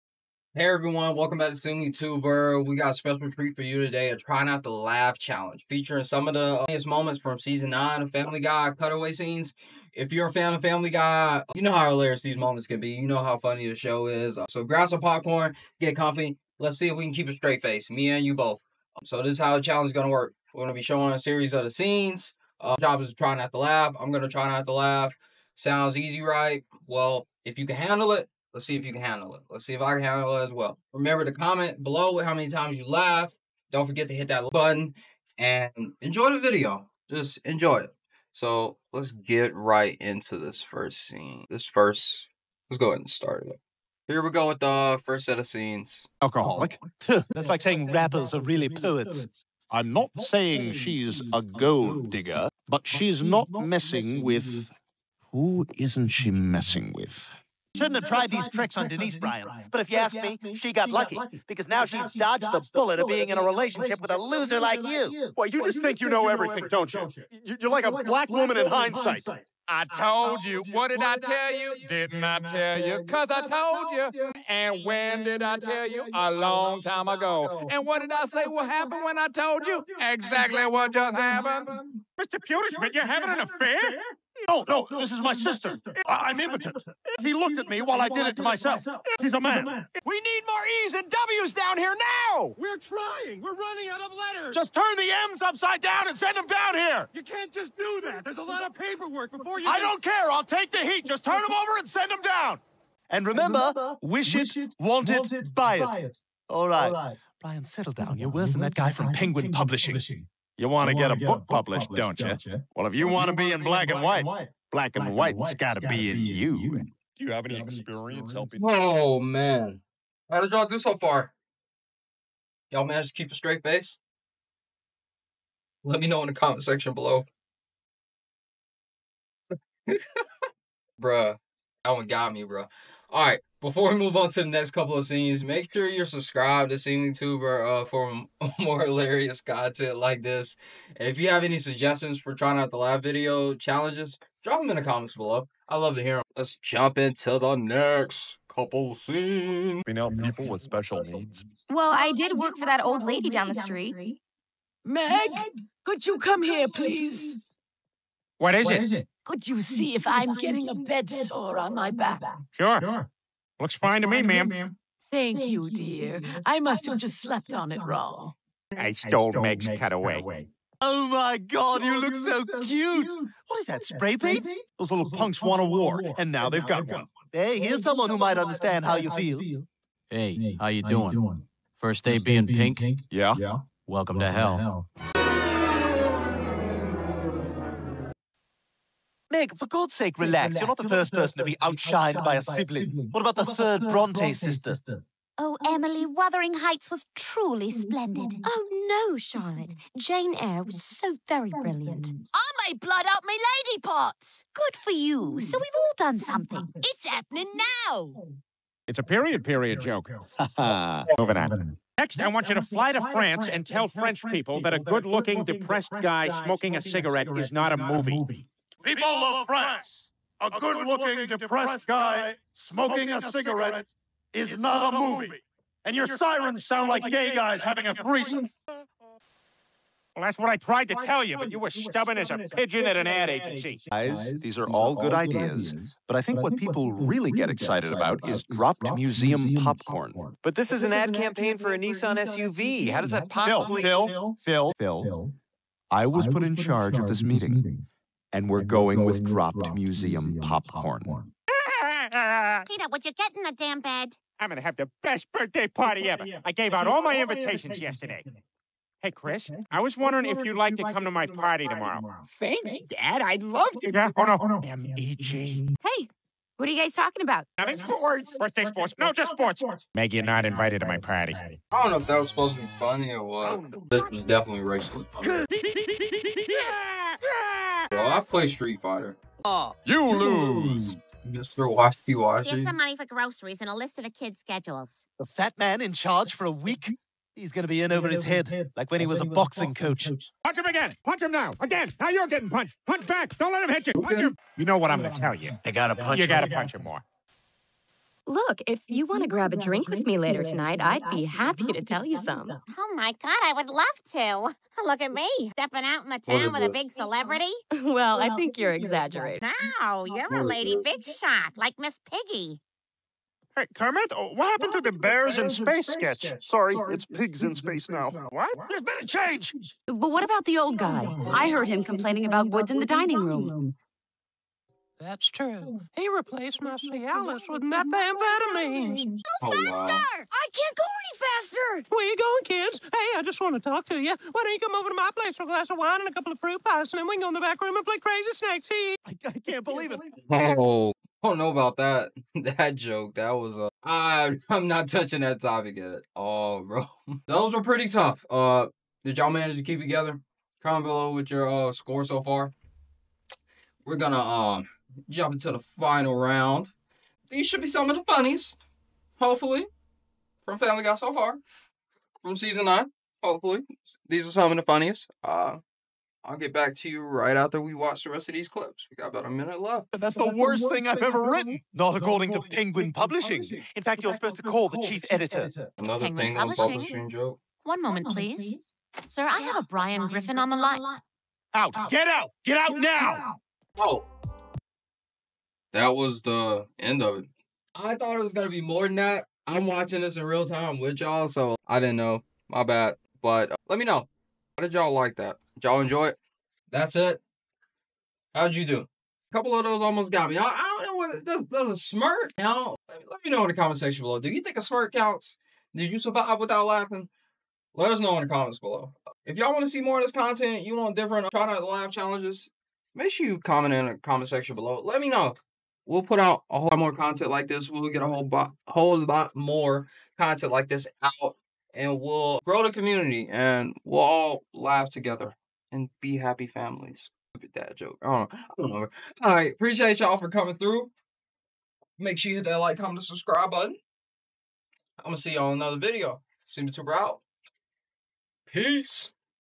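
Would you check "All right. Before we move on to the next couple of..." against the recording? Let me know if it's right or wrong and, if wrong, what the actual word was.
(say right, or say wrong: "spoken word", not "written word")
right.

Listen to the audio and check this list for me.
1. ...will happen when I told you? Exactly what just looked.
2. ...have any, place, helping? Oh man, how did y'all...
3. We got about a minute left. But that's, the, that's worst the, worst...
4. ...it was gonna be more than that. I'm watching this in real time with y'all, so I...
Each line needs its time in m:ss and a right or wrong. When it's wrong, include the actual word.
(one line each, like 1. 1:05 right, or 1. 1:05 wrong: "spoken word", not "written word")
1. 1:18 wrong: "happened", not "looked"
2. 1:57 wrong: "experience", not "place"
3. 6:08 right
4. 6:28 right.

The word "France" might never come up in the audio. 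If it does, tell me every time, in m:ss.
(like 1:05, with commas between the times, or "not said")
3:33, 3:39.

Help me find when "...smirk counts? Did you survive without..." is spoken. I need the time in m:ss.
6:44.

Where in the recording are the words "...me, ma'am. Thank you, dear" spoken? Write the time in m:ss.
2:44.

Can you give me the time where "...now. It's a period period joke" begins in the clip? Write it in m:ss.
3:27.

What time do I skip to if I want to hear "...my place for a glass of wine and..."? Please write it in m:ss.
5:34.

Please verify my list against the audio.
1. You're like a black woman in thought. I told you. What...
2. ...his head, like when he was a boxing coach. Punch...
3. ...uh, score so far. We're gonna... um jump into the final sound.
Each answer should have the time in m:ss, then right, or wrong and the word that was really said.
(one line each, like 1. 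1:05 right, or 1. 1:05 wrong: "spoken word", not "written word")
1. 1:07 wrong: "hindsight", not "thought"
2. 4:48 right
3. 5:51 wrong: "round", not "sound".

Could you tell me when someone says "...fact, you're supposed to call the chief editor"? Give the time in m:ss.
6:13.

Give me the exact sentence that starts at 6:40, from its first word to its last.
I, I don't know what does.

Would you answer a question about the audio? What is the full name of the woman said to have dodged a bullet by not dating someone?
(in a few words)
Denise Bryant.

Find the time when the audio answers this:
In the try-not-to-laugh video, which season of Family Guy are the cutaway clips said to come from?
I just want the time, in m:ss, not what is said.
0:07.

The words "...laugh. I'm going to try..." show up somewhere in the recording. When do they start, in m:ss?
0:23.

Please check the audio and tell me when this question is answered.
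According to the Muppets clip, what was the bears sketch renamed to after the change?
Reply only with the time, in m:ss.
5:17.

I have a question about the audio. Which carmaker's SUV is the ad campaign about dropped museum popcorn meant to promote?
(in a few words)
Nissan.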